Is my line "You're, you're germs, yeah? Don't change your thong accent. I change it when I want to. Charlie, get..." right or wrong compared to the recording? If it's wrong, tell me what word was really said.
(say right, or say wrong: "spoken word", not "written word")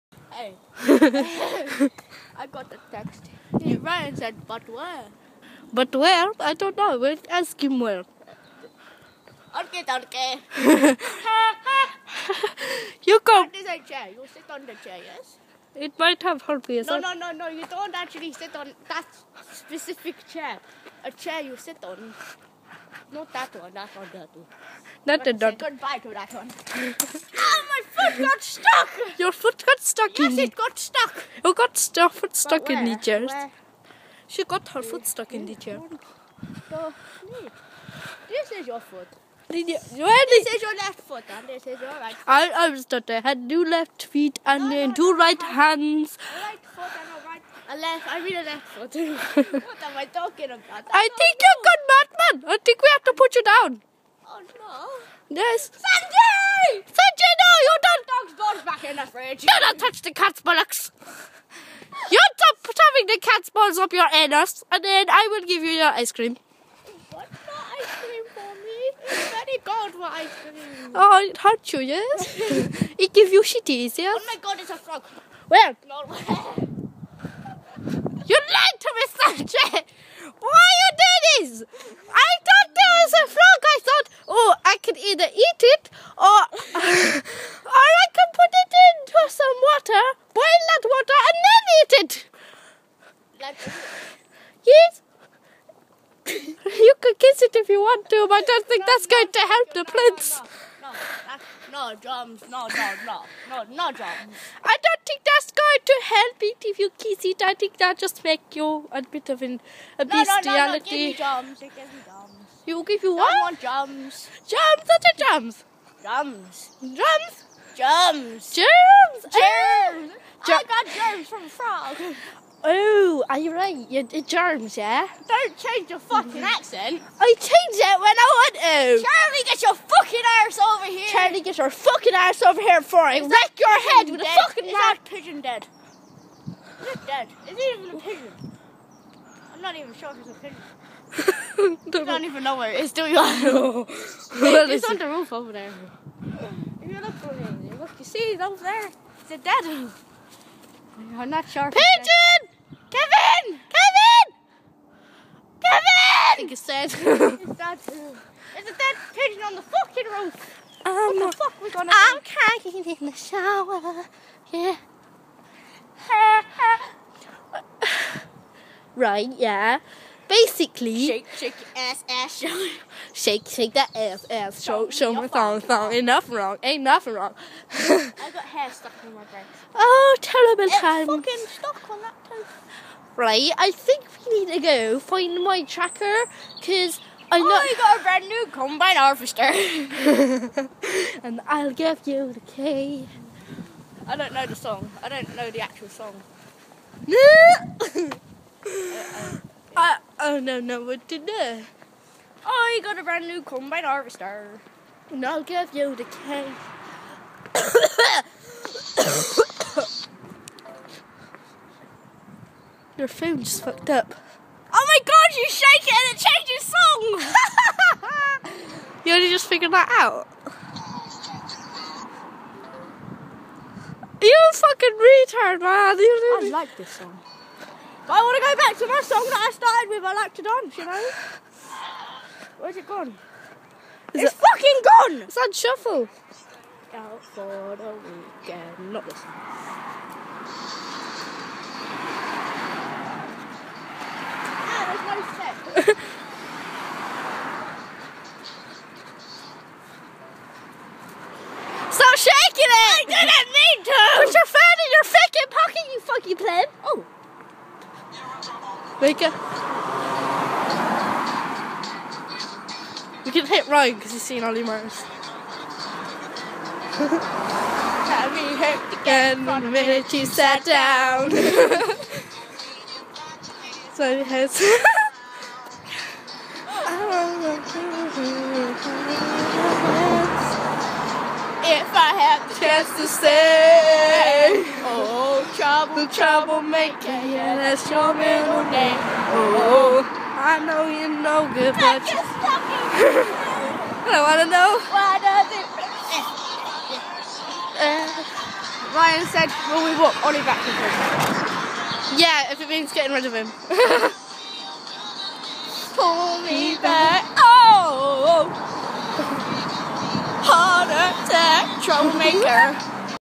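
wrong: "fucking", not "thong".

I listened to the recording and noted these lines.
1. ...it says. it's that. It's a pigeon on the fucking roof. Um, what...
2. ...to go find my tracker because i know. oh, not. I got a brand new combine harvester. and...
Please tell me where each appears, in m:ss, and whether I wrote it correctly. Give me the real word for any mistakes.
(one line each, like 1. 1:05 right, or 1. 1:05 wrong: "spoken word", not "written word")
1. 2:36 right
2. 3:04 right.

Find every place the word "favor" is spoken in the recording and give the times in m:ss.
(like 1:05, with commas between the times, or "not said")
not said.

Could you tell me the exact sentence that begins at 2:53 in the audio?
Shake, shake that ass, ass, show, show me thong, thong.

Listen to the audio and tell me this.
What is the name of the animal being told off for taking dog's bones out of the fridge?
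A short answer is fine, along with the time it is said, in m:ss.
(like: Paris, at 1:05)
Sandy, at 0:55.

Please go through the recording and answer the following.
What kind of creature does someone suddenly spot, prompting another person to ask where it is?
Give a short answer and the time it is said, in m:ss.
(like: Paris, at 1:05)
frog, at 1:14.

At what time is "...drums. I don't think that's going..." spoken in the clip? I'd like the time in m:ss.
1:43.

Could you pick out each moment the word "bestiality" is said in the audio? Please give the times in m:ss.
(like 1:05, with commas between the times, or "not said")
1:50.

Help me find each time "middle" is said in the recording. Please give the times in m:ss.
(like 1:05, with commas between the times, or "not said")
4:48.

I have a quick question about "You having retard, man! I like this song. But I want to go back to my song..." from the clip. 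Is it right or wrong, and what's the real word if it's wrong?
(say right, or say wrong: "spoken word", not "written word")
wrong: "fucking", not "having".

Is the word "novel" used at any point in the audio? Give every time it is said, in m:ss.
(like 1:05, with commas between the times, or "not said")
not said.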